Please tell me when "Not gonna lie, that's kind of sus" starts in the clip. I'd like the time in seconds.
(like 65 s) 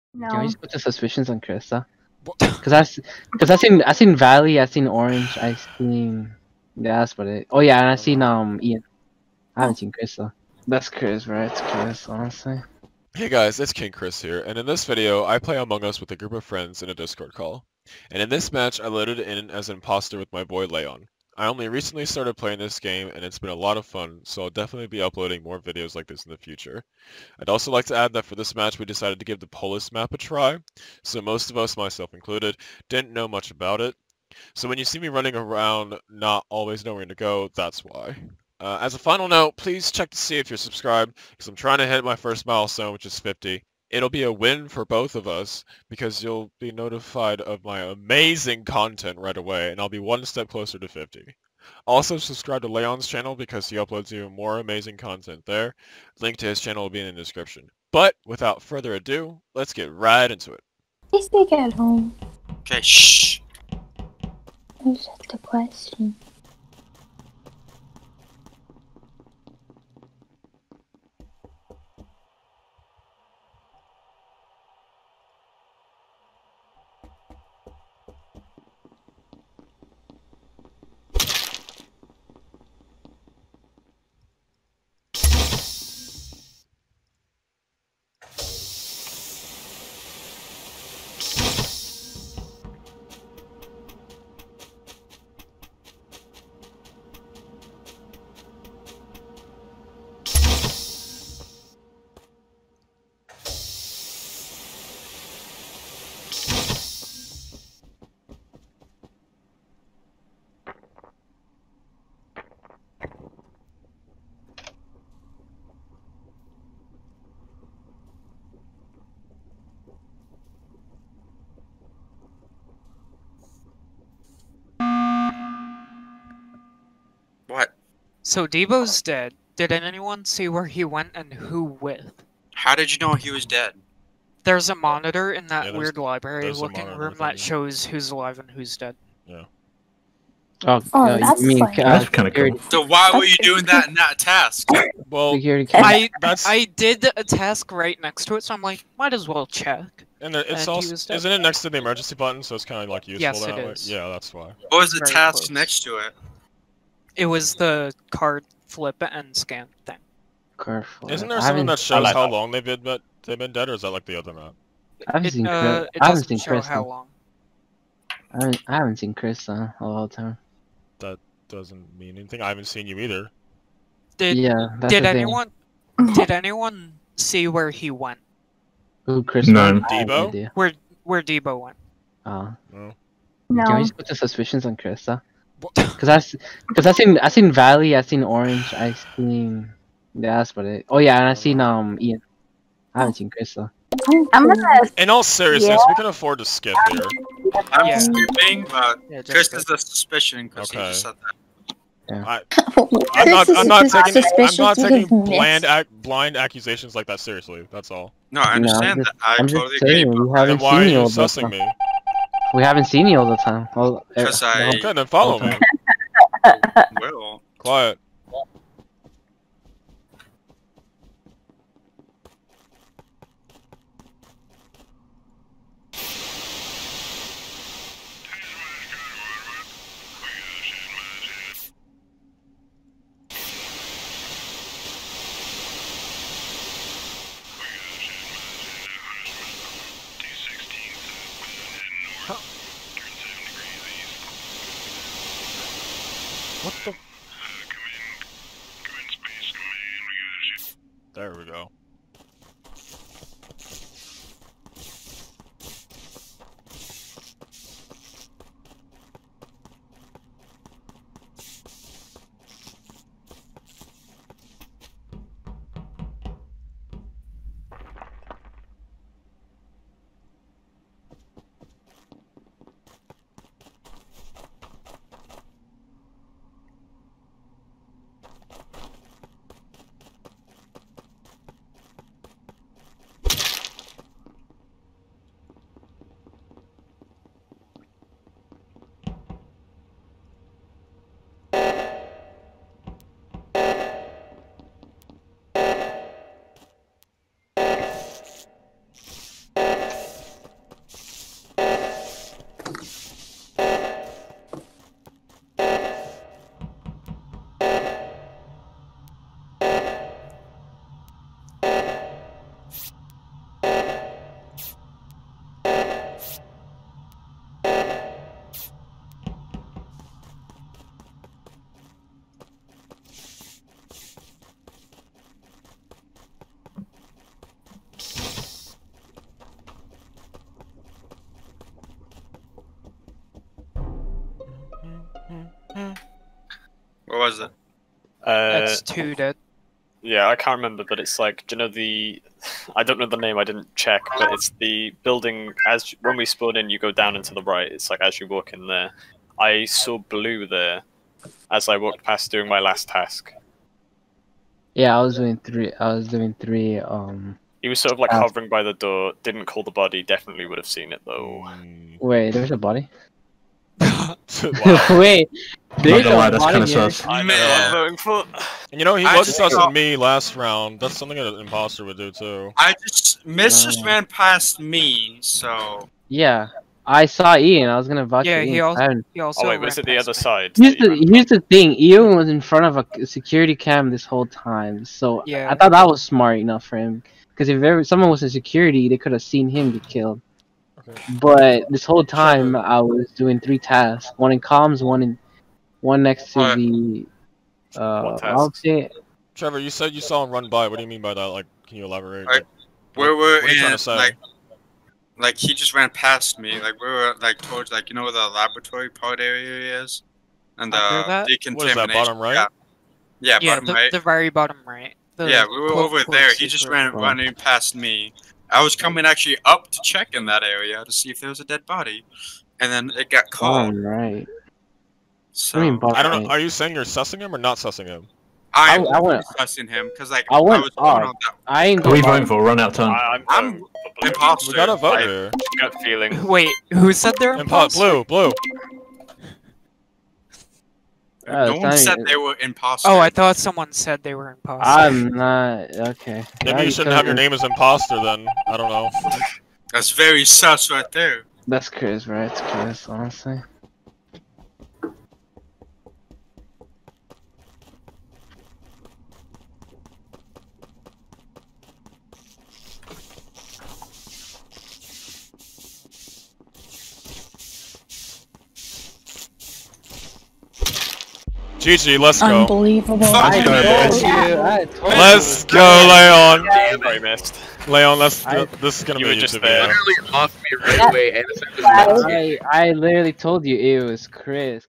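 365 s.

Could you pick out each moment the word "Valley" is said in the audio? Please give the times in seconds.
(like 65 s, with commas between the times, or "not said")
4 s, 187 s.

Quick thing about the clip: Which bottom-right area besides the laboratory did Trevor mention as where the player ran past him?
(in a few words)
decontamination.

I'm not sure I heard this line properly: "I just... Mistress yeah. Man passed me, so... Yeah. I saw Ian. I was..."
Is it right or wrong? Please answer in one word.
right.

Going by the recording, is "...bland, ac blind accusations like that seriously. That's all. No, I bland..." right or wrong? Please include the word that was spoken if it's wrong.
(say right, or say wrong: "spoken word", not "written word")
wrong: "understand", not "bland".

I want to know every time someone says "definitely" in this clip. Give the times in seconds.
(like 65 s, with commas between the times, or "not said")
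24 s, 360 s.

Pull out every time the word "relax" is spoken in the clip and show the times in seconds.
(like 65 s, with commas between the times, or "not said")
not said.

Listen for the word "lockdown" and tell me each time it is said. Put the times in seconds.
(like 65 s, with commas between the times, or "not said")
not said.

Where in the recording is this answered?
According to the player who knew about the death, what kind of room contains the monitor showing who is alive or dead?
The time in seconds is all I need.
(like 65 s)
135 s.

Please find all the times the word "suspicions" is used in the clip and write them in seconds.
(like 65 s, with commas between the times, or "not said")
0 s, 184 s, 199 s.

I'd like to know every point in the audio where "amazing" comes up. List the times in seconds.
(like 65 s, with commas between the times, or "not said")
47 s, 54 s.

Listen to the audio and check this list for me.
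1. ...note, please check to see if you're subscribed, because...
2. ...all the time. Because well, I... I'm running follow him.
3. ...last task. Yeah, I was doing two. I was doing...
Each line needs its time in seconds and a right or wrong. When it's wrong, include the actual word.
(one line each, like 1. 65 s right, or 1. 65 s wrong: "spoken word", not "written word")
1. 39 s right
2. 213 s wrong: "trying", not "running"
3. 352 s wrong: "three", not "two".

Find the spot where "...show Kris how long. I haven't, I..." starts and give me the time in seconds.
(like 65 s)
166 s.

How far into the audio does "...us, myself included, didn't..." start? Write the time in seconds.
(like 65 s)
31 s.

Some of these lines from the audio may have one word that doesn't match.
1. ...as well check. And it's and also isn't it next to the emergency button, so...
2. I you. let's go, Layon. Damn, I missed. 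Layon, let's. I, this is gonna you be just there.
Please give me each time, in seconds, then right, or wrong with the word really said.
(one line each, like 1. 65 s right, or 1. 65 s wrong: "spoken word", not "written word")
1. 149 s right
2. 473 s right.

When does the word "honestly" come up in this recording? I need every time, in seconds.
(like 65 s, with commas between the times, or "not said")
12 s, 452 s.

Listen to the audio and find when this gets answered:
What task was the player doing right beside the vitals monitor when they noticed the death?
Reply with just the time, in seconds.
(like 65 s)
158 s.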